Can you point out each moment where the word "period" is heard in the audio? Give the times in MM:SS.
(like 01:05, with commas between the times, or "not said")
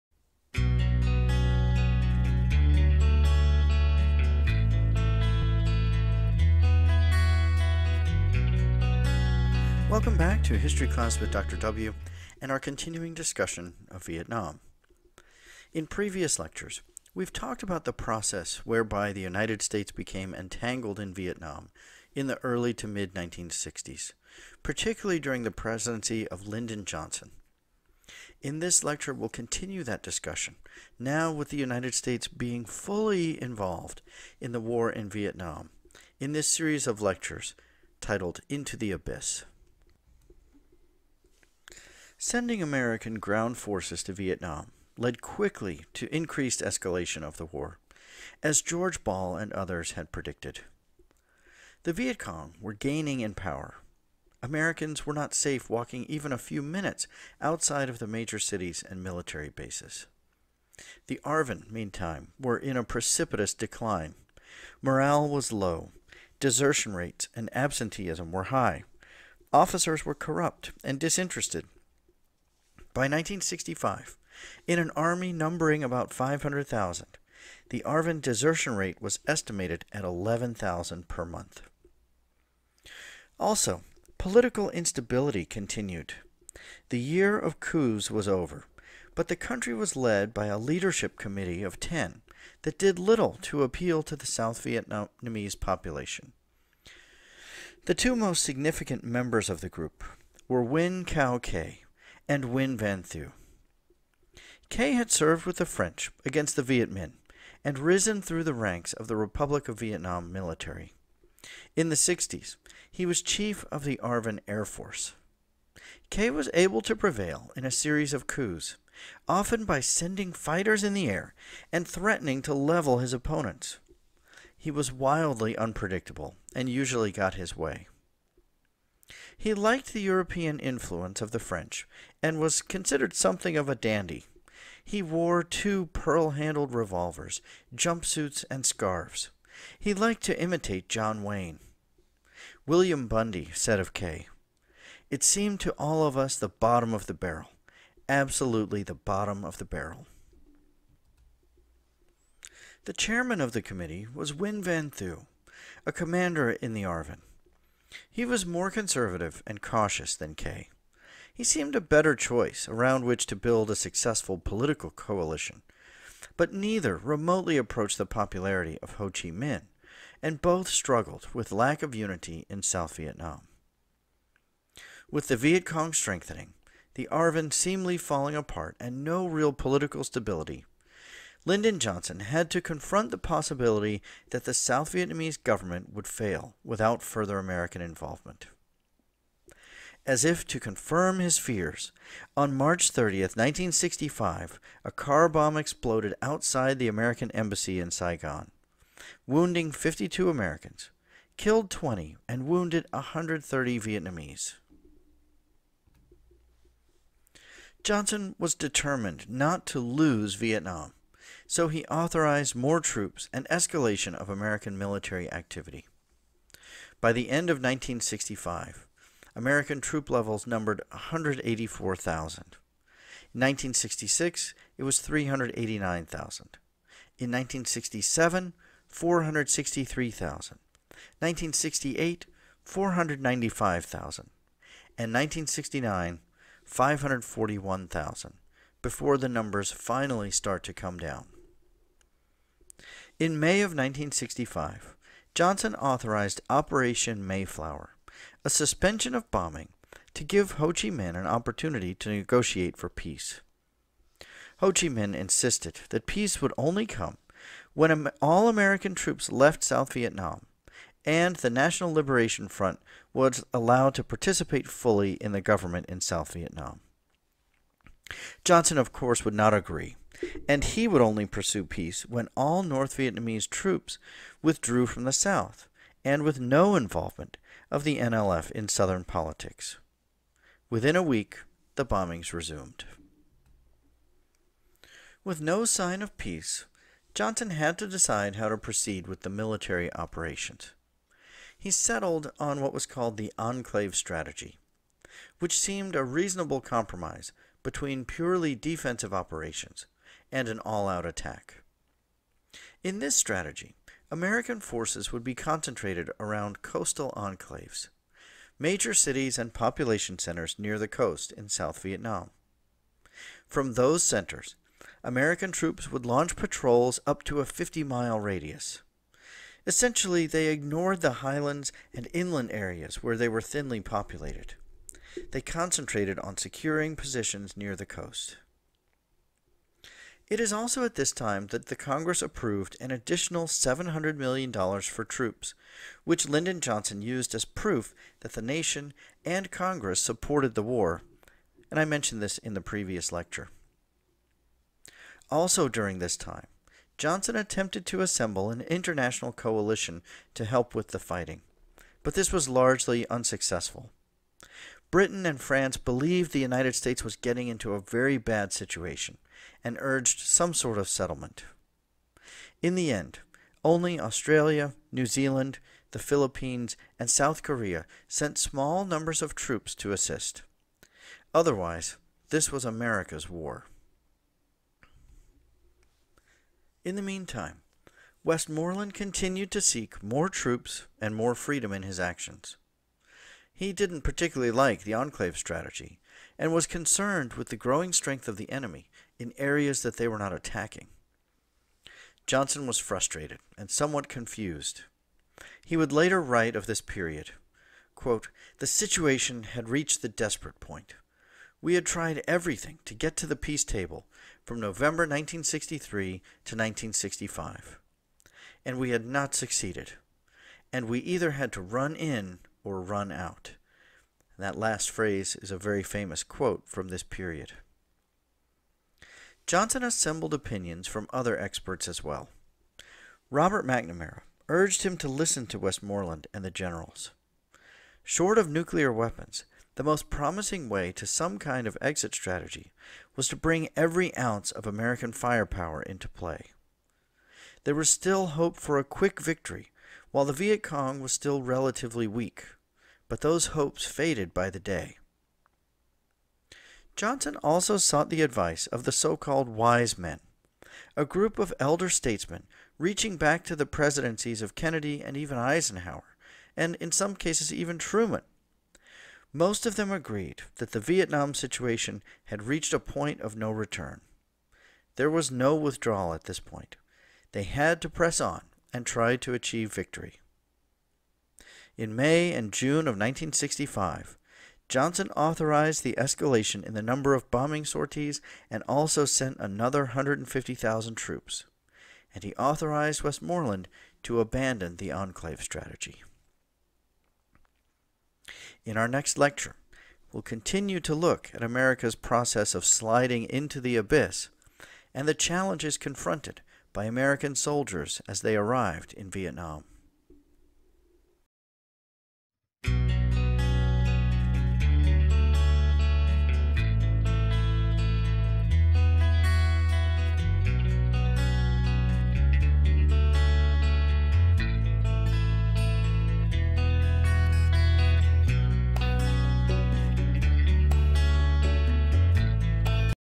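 06:36, 06:57.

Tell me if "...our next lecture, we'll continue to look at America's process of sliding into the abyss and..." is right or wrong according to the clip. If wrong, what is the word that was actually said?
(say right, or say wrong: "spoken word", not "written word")
right.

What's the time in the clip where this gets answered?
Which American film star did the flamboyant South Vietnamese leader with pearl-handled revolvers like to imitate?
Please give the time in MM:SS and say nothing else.
02:20.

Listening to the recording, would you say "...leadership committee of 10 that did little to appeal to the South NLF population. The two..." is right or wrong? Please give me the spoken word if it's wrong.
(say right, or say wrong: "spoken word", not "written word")
wrong: "Vietnamese", not "NLF".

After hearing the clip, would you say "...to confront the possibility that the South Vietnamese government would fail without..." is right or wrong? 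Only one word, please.
right.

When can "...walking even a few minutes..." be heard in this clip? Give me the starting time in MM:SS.
00:55.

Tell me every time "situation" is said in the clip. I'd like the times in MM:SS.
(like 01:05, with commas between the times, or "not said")
05:58, 06:38, 07:41.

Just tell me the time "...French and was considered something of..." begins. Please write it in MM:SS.
02:11.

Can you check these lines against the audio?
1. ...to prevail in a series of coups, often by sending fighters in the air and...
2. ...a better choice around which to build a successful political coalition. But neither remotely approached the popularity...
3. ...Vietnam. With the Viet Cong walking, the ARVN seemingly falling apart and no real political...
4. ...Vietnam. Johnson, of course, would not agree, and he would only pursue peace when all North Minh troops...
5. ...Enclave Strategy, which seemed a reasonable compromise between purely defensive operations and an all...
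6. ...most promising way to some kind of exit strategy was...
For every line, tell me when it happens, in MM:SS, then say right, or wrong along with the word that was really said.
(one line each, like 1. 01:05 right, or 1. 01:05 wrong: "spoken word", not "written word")
1. 01:56 right
2. 02:41 right
3. 02:52 wrong: "strengthening", not "walking"
4. 04:26 wrong: "Vietnamese", not "Minh"
5. 04:53 right
6. 07:09 right.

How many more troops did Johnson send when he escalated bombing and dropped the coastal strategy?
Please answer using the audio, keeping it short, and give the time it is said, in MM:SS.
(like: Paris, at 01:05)
150,000, at 07:59.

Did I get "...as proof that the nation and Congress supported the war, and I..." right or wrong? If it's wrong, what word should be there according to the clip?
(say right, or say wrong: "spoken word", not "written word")
right.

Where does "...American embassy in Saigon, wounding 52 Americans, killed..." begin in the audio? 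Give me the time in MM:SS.
03:16.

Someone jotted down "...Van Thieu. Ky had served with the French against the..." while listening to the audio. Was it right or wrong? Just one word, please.
right.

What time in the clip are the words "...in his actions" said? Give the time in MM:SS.
06:21.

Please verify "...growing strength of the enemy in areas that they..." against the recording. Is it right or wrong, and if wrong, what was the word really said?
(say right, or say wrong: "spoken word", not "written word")
right.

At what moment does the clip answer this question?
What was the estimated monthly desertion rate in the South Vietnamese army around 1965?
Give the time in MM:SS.
01:20.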